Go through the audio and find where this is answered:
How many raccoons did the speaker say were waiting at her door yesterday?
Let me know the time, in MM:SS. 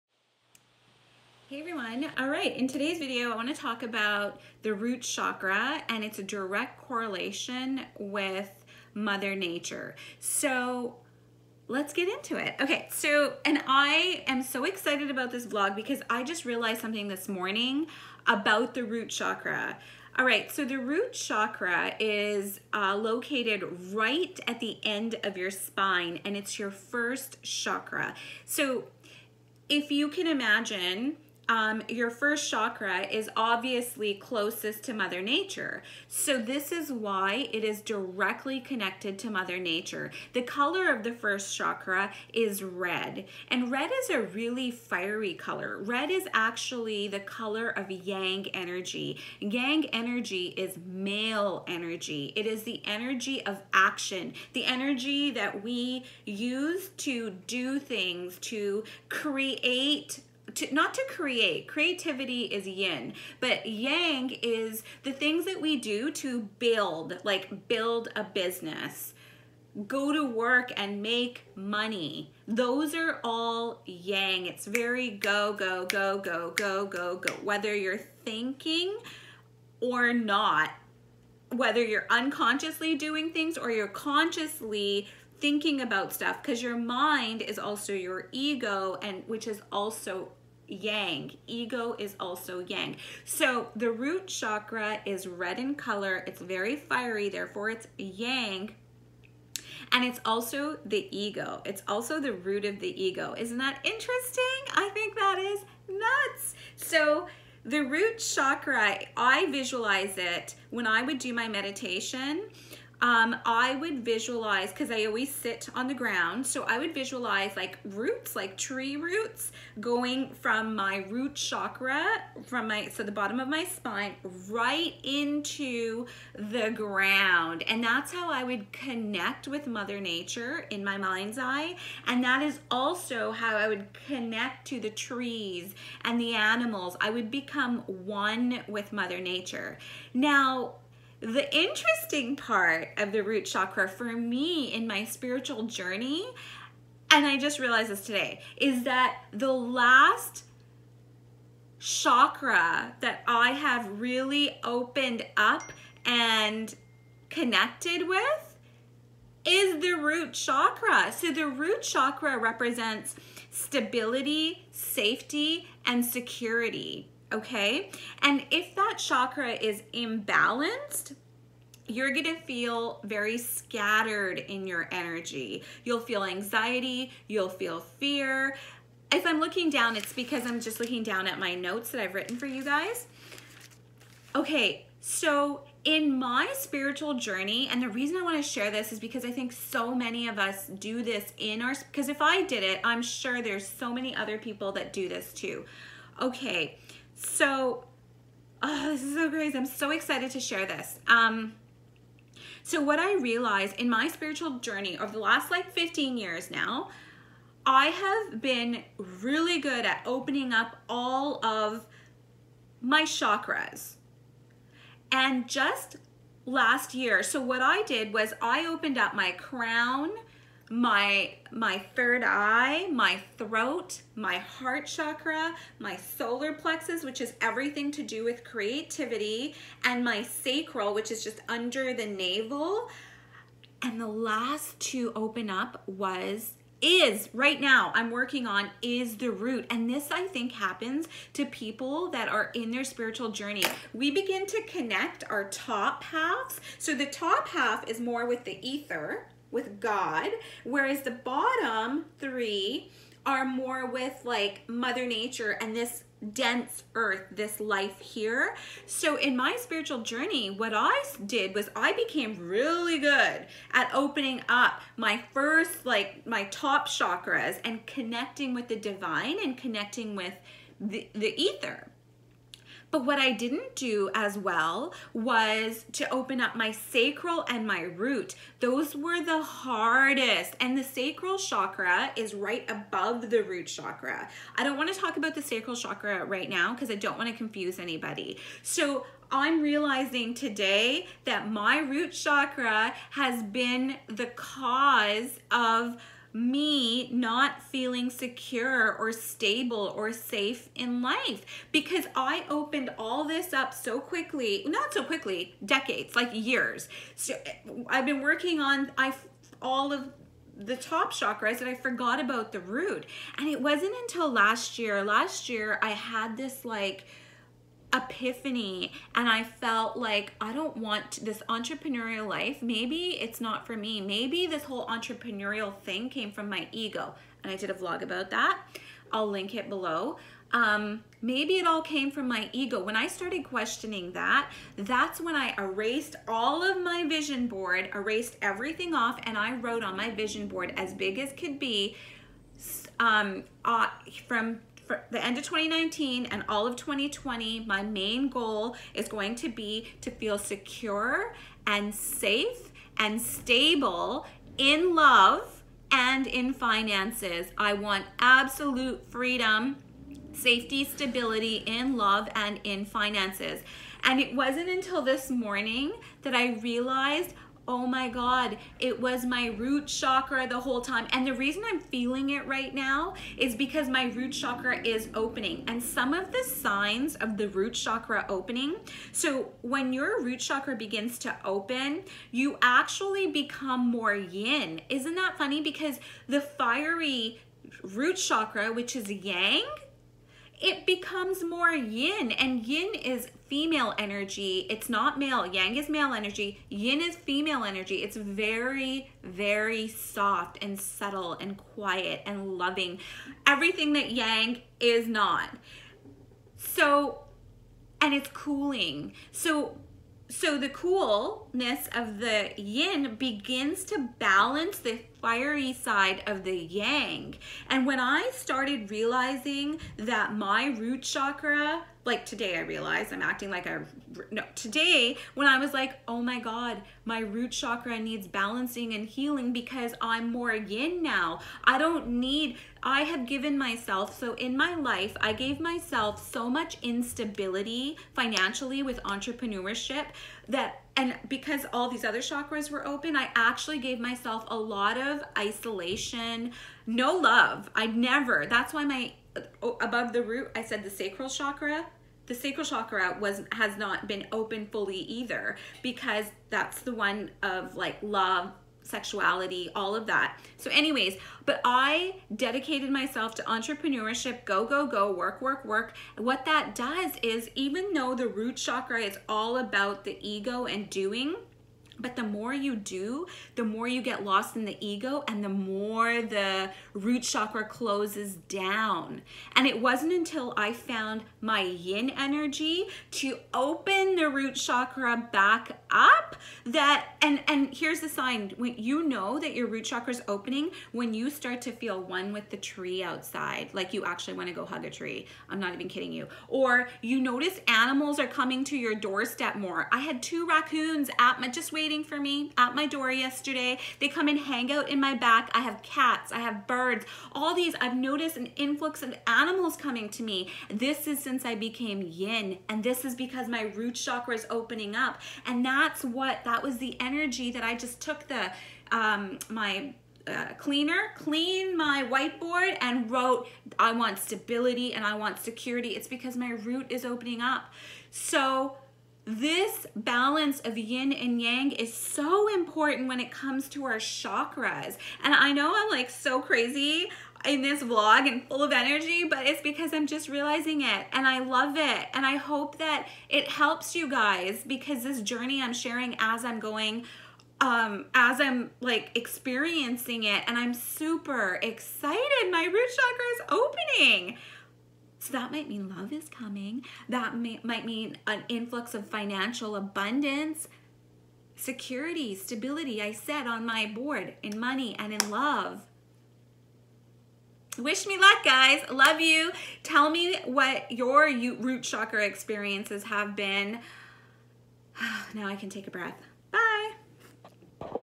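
08:20.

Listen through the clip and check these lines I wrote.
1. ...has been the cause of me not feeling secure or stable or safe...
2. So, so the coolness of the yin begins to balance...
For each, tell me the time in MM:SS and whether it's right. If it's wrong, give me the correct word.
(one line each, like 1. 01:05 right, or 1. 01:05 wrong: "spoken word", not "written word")
1. 04:53 right
2. 06:49 right.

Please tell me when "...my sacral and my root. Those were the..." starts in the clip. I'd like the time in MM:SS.
04:36.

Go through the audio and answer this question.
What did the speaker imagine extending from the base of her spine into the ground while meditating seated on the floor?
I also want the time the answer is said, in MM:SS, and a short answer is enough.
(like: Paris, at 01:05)
Tree roots, at 01:58.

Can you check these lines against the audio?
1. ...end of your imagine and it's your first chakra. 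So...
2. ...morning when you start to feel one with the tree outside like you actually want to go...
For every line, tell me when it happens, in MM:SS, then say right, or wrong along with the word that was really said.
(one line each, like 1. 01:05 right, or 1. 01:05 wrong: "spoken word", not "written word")
1. 00:24 wrong: "spine", not "imagine"
2. 08:10 wrong: "opening", not "morning".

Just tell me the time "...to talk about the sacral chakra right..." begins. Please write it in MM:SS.
04:44.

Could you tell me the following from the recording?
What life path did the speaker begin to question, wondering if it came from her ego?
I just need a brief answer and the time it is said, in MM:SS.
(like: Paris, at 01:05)
Entrepreneurial life, at 05:21.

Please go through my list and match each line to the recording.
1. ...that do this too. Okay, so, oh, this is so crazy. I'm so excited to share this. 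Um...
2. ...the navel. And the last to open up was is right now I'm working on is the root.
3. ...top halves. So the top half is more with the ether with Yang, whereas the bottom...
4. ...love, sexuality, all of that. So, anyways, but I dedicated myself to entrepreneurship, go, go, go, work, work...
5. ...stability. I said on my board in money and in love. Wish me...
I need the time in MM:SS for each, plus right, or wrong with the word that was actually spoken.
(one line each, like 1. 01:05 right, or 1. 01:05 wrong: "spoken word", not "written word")
1. 03:14 right
2. 03:51 right
3. 04:05 wrong: "God", not "Yang"
4. 07:38 right
5. 09:22 right.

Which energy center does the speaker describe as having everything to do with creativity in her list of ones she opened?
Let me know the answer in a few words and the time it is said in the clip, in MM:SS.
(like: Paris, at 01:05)
Solar plexus, at 03:45.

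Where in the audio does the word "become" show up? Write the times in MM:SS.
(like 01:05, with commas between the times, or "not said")
02:17, 06:23, 06:30.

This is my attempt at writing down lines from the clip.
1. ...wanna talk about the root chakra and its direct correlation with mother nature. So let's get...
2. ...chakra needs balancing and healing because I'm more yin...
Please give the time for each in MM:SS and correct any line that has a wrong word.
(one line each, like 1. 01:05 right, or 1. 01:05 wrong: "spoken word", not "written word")
1. 00:03 right
2. 07:07 right.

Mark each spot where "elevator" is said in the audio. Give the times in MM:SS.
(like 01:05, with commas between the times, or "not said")
not said.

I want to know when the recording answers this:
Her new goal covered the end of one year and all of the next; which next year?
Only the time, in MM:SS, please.
05:46.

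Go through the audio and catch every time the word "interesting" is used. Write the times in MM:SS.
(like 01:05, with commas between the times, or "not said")
01:43, 02:21.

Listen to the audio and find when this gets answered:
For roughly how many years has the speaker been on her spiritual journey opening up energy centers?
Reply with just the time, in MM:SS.
03:25.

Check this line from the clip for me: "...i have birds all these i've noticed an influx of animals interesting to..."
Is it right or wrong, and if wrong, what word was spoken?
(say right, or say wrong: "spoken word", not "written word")
wrong: "coming", not "interesting".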